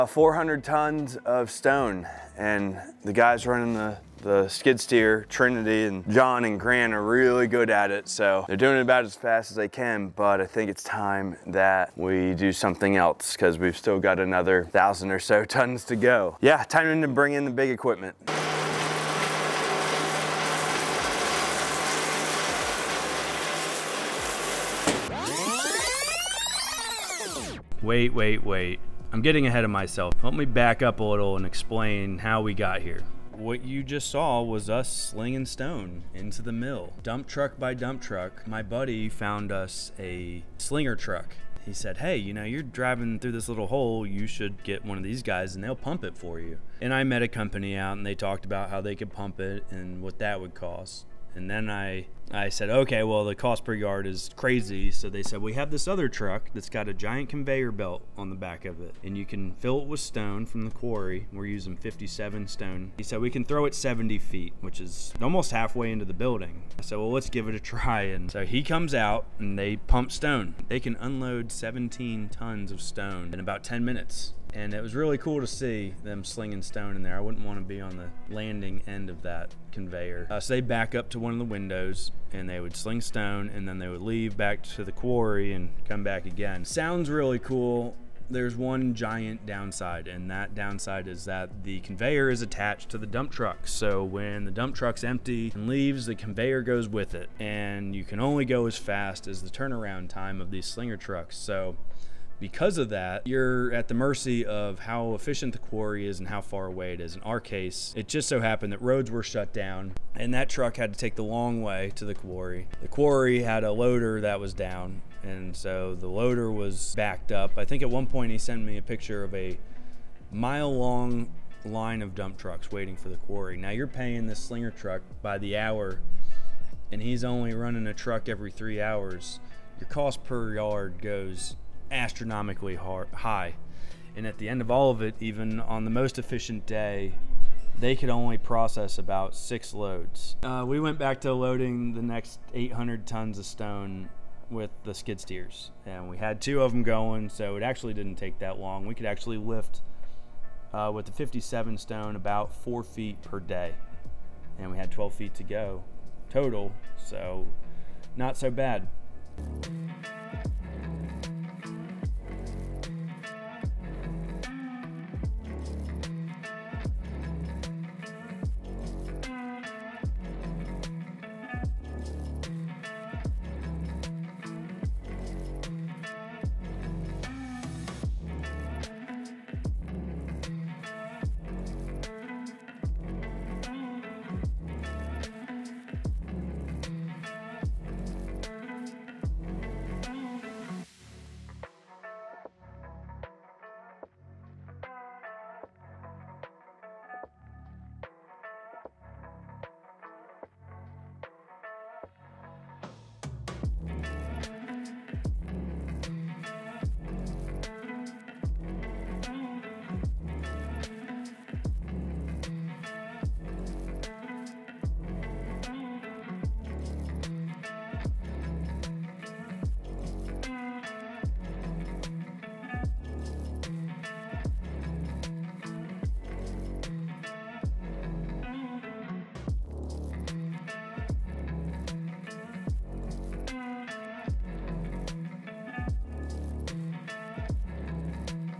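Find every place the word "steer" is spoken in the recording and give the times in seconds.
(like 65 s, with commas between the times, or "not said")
4 s, 145 s.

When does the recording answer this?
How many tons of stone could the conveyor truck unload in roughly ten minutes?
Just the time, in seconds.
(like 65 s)
71 s.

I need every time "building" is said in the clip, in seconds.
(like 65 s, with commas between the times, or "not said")
66 s.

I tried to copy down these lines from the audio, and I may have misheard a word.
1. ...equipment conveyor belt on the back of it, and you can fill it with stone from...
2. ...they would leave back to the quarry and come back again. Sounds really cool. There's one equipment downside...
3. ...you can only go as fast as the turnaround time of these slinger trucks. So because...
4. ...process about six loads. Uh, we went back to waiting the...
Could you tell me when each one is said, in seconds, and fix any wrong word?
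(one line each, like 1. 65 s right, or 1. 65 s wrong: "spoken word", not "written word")
1. 56 s wrong: "giant", not "equipment"
2. 83 s wrong: "giant", not "equipment"
3. 97 s right
4. 138 s wrong: "loading", not "waiting".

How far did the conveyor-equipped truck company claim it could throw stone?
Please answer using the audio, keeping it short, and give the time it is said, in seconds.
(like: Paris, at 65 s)
70 feet, at 63 s.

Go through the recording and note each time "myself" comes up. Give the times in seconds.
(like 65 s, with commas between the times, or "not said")
29 s.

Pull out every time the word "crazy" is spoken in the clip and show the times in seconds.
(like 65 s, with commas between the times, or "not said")
54 s.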